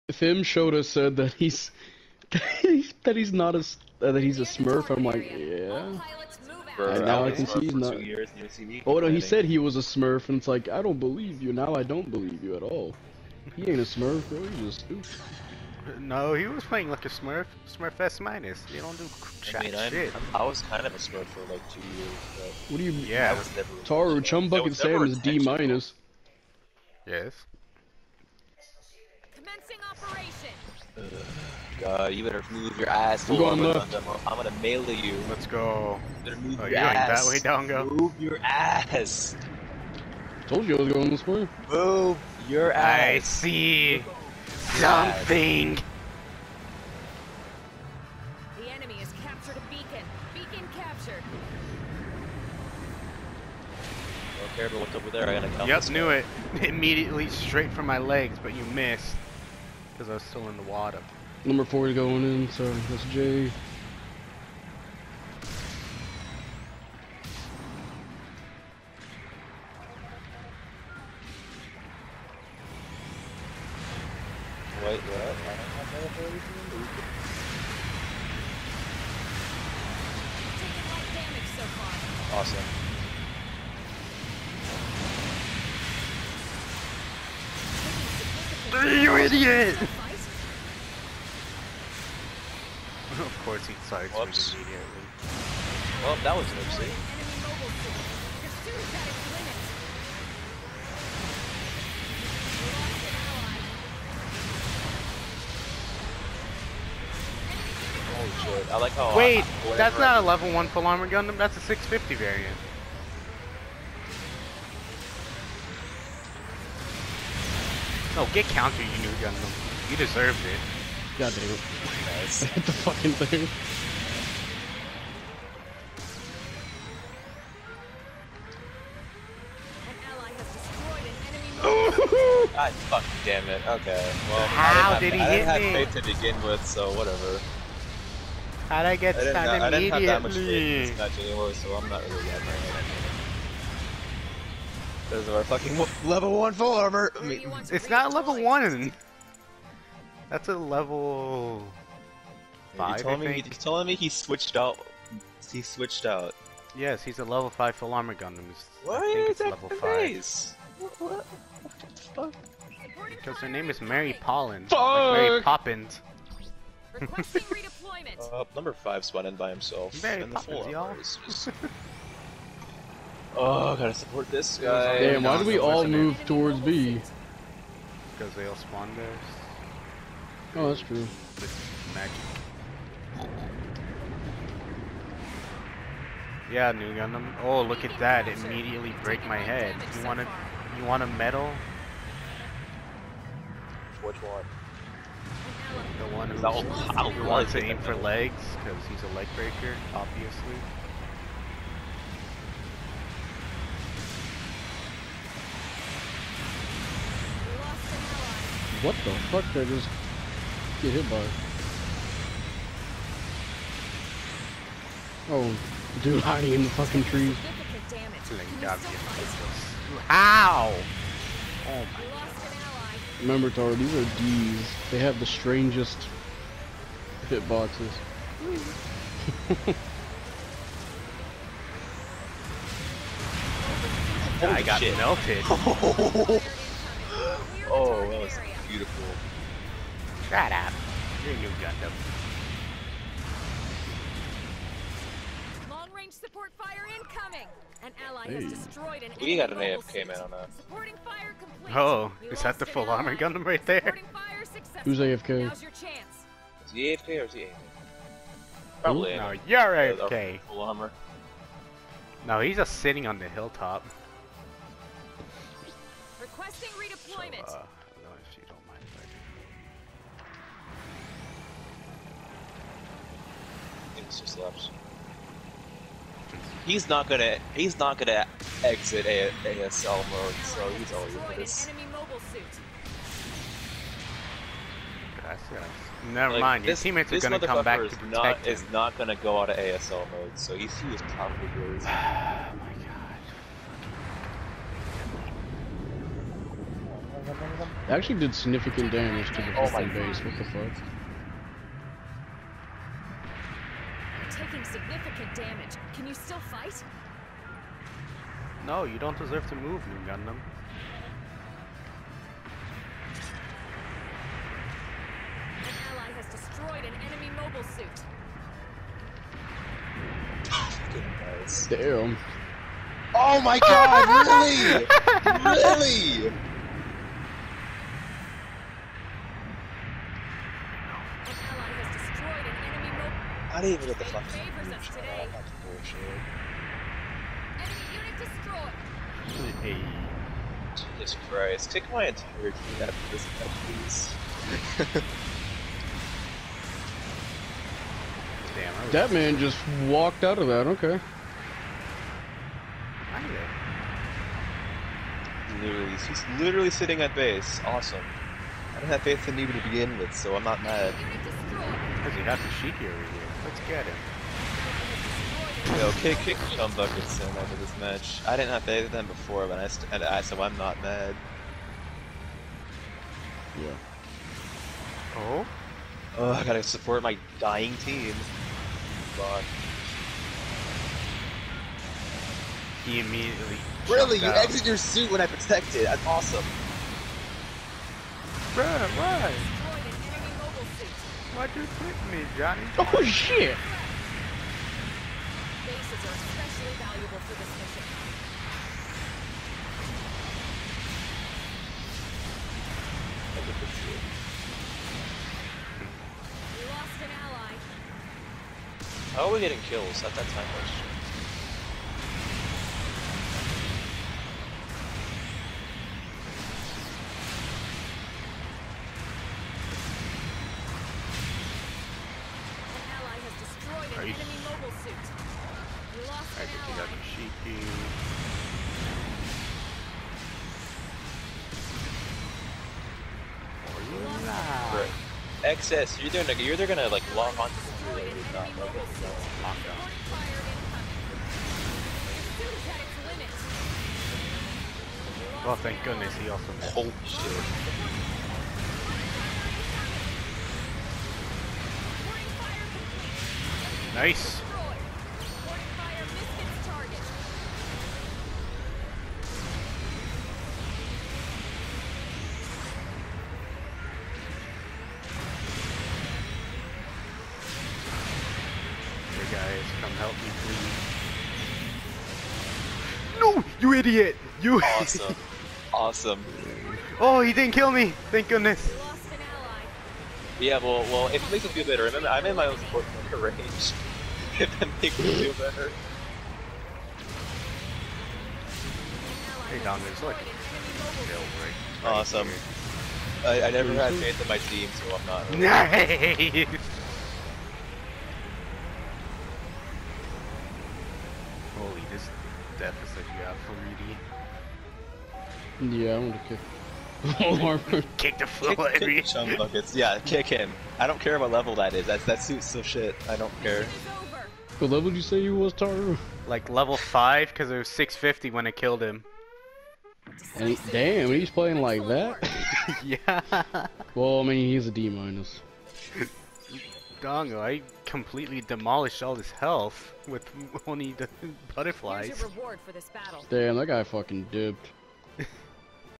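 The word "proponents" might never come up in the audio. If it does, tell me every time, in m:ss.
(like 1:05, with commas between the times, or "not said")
not said.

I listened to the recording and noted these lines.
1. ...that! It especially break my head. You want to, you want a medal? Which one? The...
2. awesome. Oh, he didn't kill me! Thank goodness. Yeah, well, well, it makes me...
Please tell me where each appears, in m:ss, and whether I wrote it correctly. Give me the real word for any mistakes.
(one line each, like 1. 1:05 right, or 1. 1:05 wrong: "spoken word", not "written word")
1. 3:07 wrong: "immediately", not "especially"
2. 7:55 right.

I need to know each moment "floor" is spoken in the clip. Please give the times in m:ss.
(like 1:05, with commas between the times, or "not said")
8:28.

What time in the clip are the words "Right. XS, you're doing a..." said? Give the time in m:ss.
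7:14.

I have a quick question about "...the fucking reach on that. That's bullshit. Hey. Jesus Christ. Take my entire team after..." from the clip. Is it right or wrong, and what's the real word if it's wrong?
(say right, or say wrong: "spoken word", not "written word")
right.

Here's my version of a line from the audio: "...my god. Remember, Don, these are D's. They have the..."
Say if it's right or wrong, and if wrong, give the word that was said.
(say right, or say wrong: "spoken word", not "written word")
wrong: "Taru", not "Don".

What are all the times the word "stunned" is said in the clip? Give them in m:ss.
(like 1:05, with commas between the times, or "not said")
2:19.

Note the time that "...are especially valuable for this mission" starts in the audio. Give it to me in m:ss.
6:36.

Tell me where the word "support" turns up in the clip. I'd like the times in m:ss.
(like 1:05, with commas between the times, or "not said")
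2:53, 4:06, 6:16, 8:02.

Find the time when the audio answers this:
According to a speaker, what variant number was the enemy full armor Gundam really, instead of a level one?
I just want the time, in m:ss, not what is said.
1:51.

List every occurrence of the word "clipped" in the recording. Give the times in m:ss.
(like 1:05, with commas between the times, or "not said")
6:31.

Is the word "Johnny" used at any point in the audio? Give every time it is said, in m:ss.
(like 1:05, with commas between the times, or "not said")
6:32.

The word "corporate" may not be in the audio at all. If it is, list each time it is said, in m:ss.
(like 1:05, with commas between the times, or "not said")
not said.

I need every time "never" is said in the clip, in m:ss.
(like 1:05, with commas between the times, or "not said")
4:46, 8:13.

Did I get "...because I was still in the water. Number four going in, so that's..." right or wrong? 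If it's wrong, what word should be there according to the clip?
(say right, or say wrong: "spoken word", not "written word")
right.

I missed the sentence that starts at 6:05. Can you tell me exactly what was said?
Yo, kick, kick Sean Bucket so this match.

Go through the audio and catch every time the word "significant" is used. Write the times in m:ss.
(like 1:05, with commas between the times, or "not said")
4:58, 5:04.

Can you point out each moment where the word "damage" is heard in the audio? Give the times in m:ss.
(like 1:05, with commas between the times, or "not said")
4:58, 5:05.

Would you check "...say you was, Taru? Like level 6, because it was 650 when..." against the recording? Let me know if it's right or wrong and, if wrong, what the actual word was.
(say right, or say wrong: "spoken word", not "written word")
wrong: "5", not "6".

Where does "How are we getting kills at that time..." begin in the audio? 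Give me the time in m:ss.
6:49.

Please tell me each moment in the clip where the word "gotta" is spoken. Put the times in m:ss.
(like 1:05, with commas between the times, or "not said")
0:55, 2:53, 6:16.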